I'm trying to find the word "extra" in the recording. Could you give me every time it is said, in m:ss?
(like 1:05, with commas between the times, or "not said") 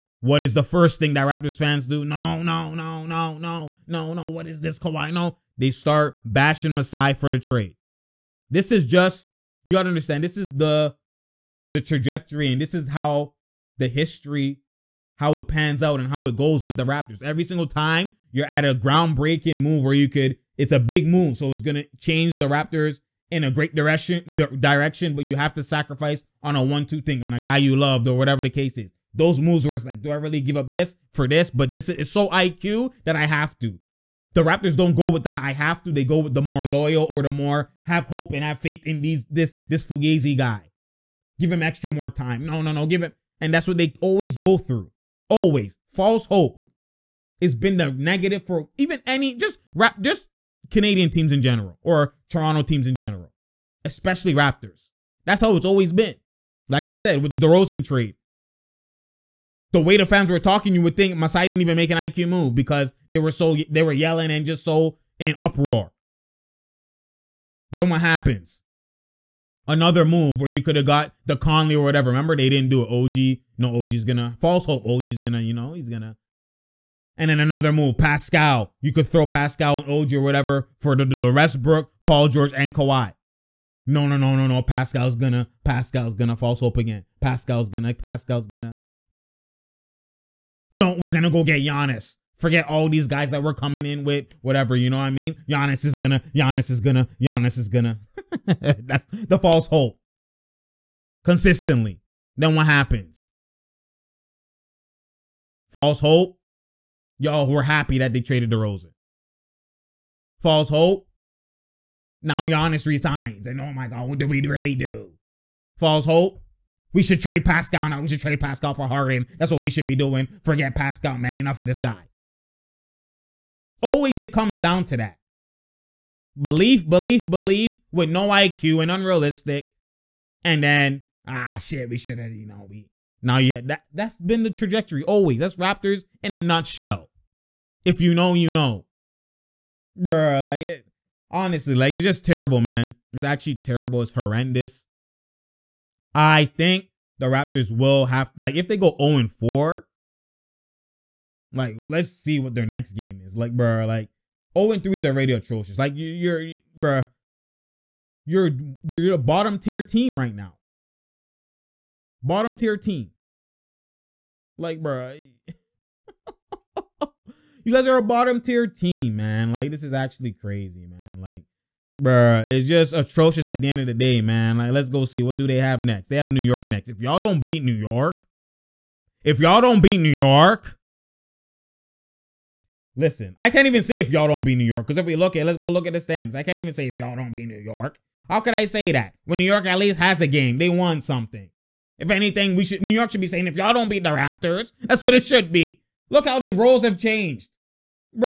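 0:41.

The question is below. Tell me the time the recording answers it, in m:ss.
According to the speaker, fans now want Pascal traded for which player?
1:58.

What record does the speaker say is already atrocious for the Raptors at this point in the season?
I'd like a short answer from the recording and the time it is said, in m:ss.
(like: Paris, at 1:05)
0-3, at 2:34.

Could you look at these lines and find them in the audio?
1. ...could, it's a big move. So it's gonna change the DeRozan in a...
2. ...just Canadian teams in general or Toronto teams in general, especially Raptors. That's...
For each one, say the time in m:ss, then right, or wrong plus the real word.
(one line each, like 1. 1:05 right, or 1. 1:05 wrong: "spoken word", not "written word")
1. 0:20 wrong: "Raptors", not "DeRozan"
2. 0:50 right.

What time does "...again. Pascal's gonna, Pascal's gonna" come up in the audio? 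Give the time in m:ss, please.
1:26.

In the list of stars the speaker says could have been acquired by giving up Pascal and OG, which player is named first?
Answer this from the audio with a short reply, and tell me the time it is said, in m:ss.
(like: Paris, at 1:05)
Westbrook, at 1:21.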